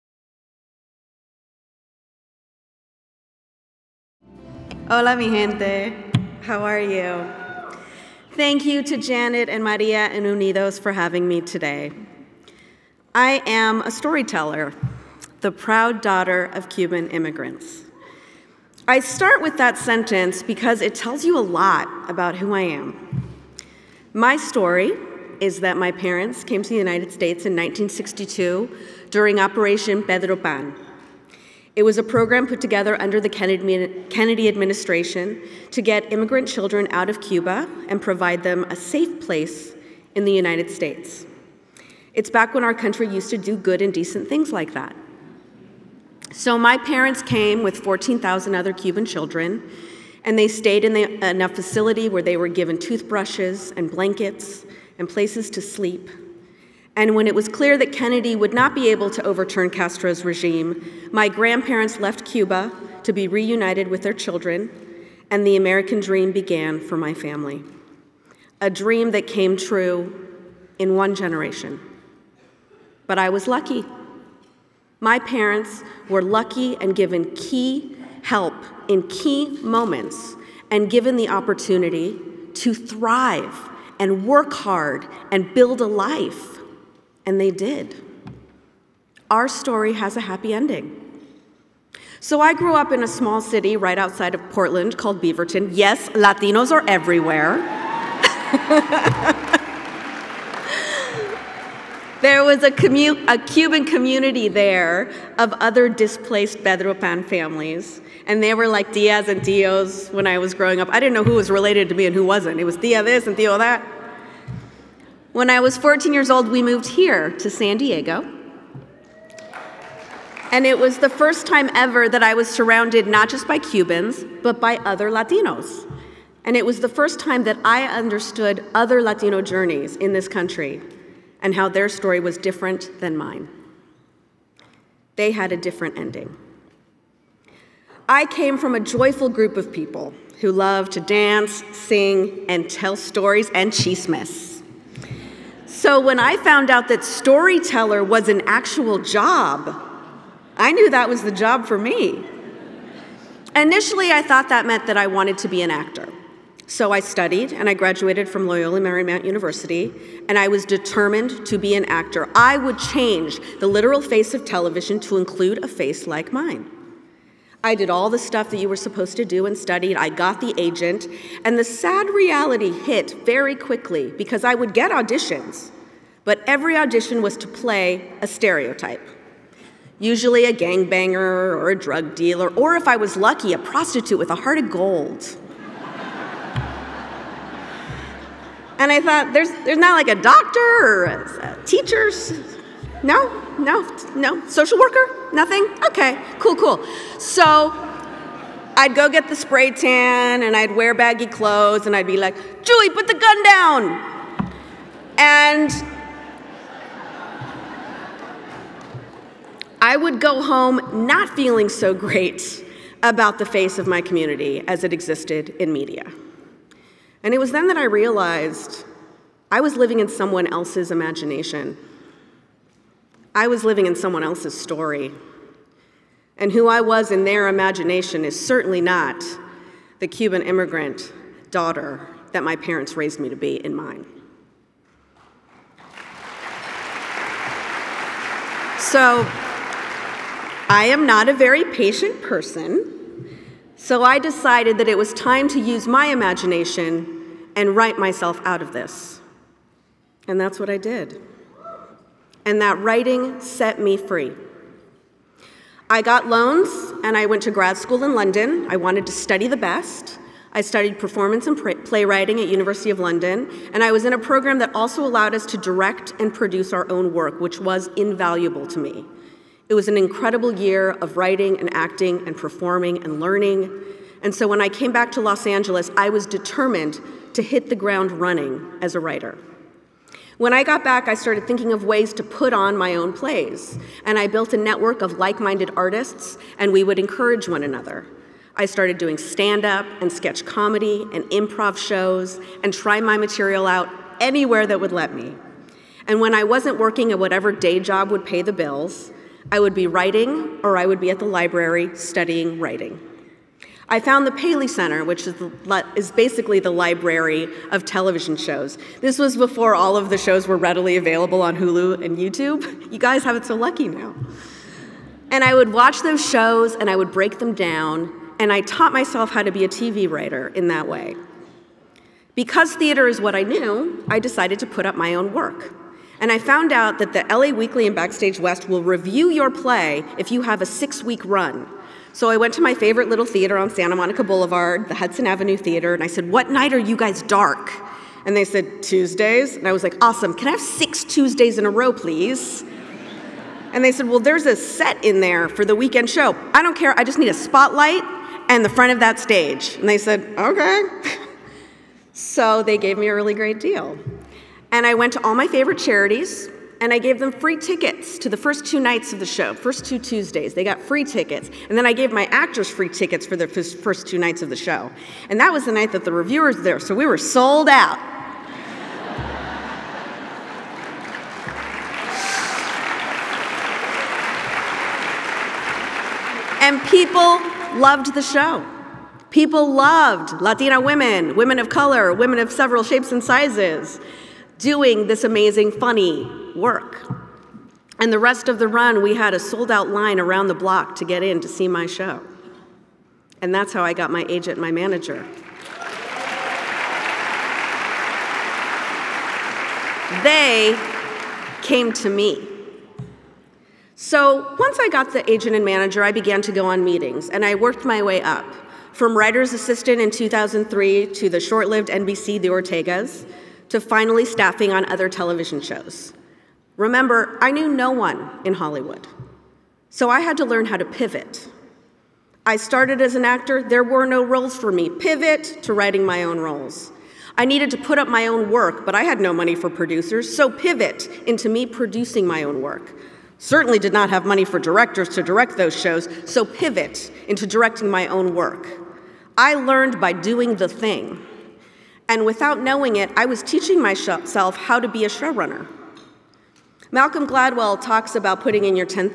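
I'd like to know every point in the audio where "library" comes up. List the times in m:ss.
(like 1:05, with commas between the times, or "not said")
5:01, 5:06.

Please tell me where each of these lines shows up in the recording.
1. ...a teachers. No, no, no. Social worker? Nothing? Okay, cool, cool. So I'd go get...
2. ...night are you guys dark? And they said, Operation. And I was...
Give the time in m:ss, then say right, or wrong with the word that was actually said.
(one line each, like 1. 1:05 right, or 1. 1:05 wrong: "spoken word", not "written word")
1. 3:11 right
2. 5:36 wrong: "Tuesdays", not "Operation".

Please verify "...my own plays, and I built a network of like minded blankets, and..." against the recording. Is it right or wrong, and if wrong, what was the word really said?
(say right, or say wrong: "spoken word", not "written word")
wrong: "artists", not "blankets".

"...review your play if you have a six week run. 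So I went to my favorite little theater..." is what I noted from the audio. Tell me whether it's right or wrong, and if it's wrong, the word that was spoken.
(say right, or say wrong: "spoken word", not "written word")
right.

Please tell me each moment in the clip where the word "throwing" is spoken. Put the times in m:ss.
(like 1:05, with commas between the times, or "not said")
not said.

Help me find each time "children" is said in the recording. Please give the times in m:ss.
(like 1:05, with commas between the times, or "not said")
0:36, 0:49, 1:04.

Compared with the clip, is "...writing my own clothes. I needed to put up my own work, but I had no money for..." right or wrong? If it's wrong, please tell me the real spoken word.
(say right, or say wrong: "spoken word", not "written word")
wrong: "roles", not "clothes".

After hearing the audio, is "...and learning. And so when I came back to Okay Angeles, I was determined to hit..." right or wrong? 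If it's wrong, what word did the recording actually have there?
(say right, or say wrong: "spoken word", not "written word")
wrong: "Los", not "Okay".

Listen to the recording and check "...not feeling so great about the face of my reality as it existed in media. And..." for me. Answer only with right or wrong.
wrong.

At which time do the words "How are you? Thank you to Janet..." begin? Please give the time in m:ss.
0:06.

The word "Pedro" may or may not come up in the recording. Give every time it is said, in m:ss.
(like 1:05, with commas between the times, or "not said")
0:30, 1:46.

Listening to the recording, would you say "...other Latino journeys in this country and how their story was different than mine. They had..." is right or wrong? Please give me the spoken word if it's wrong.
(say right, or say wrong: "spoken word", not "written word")
right.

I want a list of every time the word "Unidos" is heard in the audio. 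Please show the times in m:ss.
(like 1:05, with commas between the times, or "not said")
0:10.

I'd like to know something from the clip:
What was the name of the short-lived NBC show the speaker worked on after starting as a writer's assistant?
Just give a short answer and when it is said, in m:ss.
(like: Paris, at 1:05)
The Ortegas, at 6:52.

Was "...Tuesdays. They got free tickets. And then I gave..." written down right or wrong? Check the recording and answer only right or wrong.
right.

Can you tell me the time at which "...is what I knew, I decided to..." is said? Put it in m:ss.
5:23.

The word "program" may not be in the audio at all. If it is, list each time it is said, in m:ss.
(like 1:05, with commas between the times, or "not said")
0:32, 4:24.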